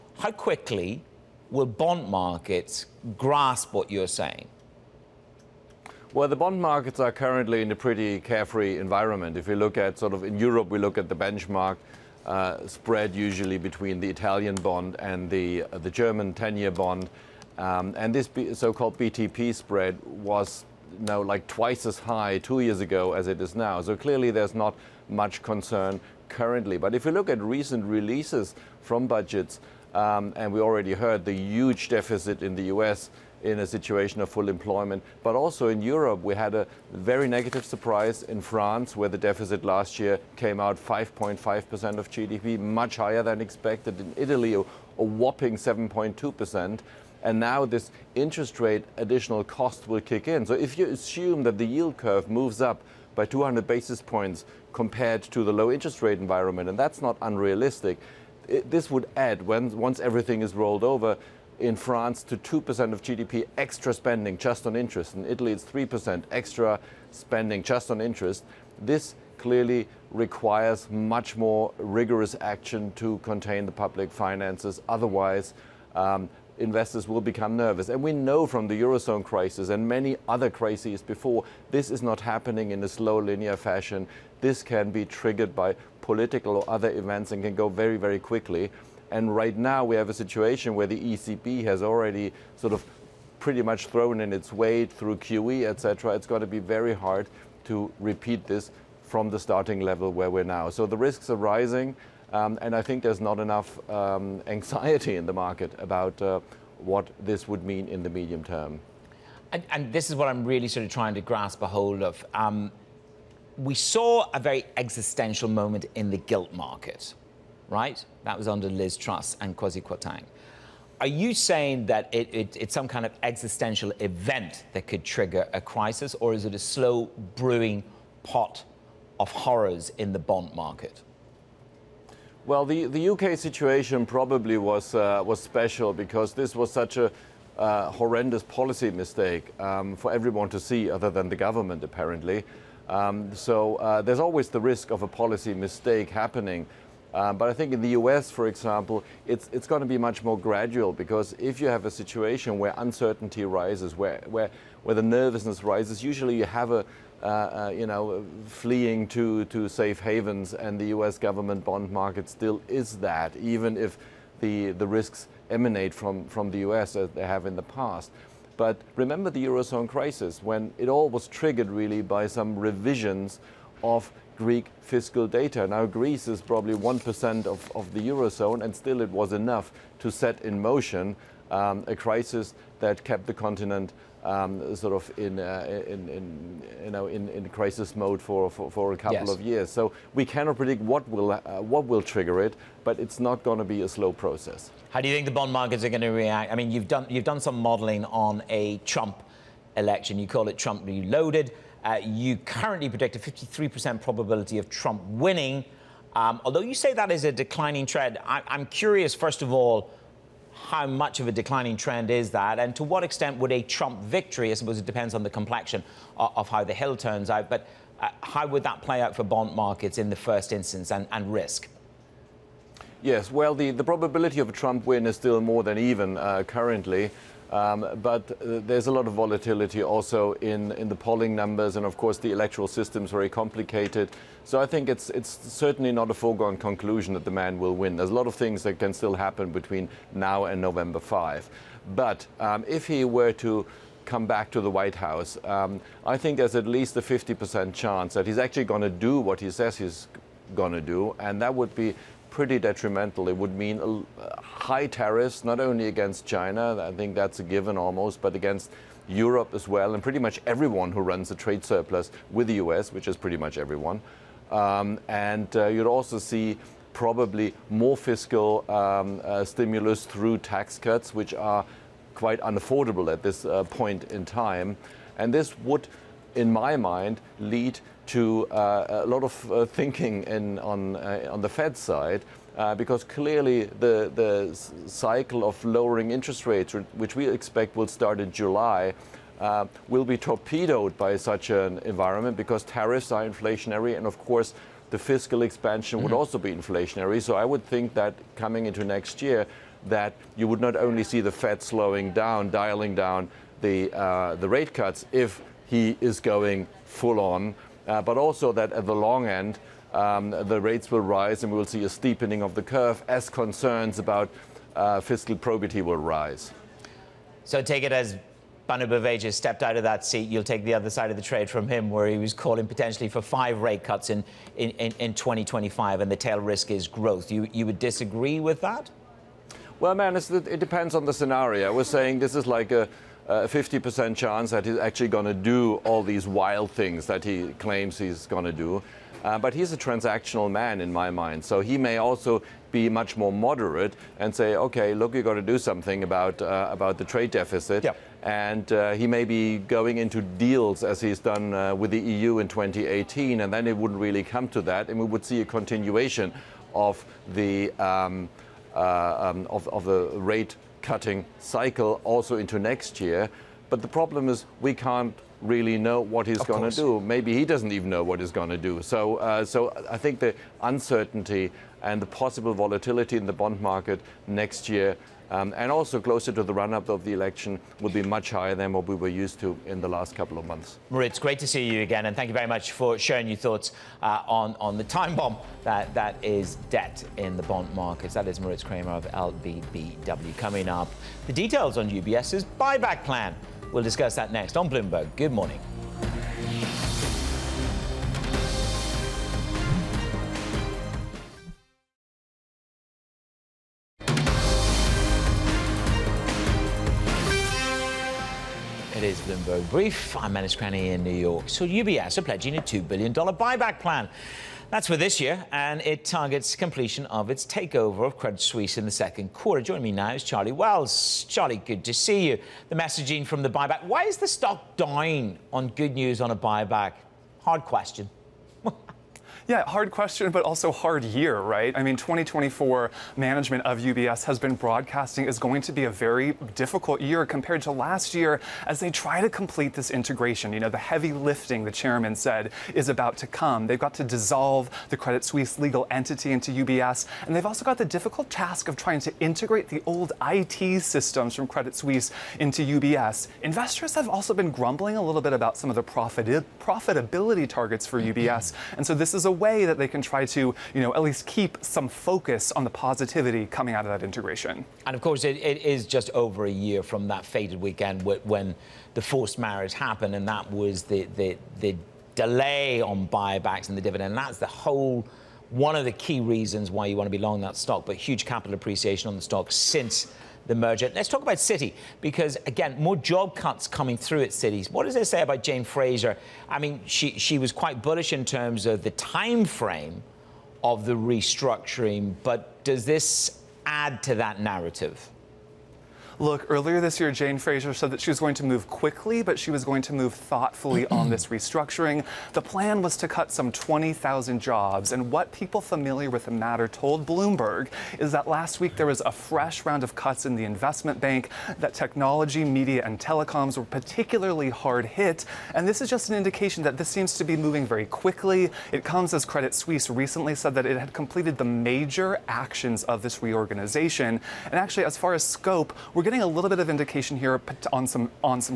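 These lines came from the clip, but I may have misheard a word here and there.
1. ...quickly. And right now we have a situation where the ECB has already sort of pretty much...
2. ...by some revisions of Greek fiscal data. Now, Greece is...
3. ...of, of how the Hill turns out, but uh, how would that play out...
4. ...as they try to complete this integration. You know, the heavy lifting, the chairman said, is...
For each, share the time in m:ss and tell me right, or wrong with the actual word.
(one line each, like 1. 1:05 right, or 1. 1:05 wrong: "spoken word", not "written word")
1. 1:28 right
2. 2:52 right
3. 3:36 right
4. 7:18 right.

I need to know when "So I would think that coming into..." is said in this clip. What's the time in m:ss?
4:57.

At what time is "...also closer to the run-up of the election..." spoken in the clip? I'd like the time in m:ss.
6:15.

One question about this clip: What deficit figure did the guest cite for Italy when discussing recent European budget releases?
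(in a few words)
7.2%.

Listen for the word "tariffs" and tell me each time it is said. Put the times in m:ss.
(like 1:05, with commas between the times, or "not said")
4:14, 4:52.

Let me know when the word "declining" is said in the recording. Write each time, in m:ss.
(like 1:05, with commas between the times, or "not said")
3:27, 3:31.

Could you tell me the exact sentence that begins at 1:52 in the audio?
Um, we saw a very existential moment in the gilt market right?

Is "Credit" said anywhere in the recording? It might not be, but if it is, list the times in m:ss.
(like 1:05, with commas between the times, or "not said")
6:58, 7:24, 7:31, 8:39.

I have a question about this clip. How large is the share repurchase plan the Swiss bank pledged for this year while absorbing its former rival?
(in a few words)
$2 billion.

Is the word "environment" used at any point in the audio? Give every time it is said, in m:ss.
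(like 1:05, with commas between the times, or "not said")
0:08, 0:56, 4:51.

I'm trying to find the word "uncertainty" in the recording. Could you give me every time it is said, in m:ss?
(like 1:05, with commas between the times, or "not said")
2:32, 6:10.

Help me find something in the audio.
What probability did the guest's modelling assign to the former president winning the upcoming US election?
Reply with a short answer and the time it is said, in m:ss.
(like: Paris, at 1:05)
53%, at 3:23.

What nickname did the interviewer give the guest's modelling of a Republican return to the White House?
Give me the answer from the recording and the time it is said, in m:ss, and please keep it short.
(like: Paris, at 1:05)
Trump reloaded, at 3:20.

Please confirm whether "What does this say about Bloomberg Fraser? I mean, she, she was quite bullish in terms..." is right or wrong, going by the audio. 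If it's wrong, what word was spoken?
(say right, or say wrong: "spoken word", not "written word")
wrong: "Jane", not "Bloomberg".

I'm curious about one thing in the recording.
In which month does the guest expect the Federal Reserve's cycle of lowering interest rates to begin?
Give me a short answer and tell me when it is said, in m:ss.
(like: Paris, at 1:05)
July, at 4:48.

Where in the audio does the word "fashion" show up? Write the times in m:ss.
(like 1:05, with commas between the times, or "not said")
1:23.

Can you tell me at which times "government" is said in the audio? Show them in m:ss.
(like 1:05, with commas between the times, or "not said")
2:21, 2:41.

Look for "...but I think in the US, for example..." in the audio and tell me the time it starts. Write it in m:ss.
2:27.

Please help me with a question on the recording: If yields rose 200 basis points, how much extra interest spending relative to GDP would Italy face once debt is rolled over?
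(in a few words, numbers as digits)
3%.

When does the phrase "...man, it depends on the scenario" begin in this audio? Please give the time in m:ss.
5:29.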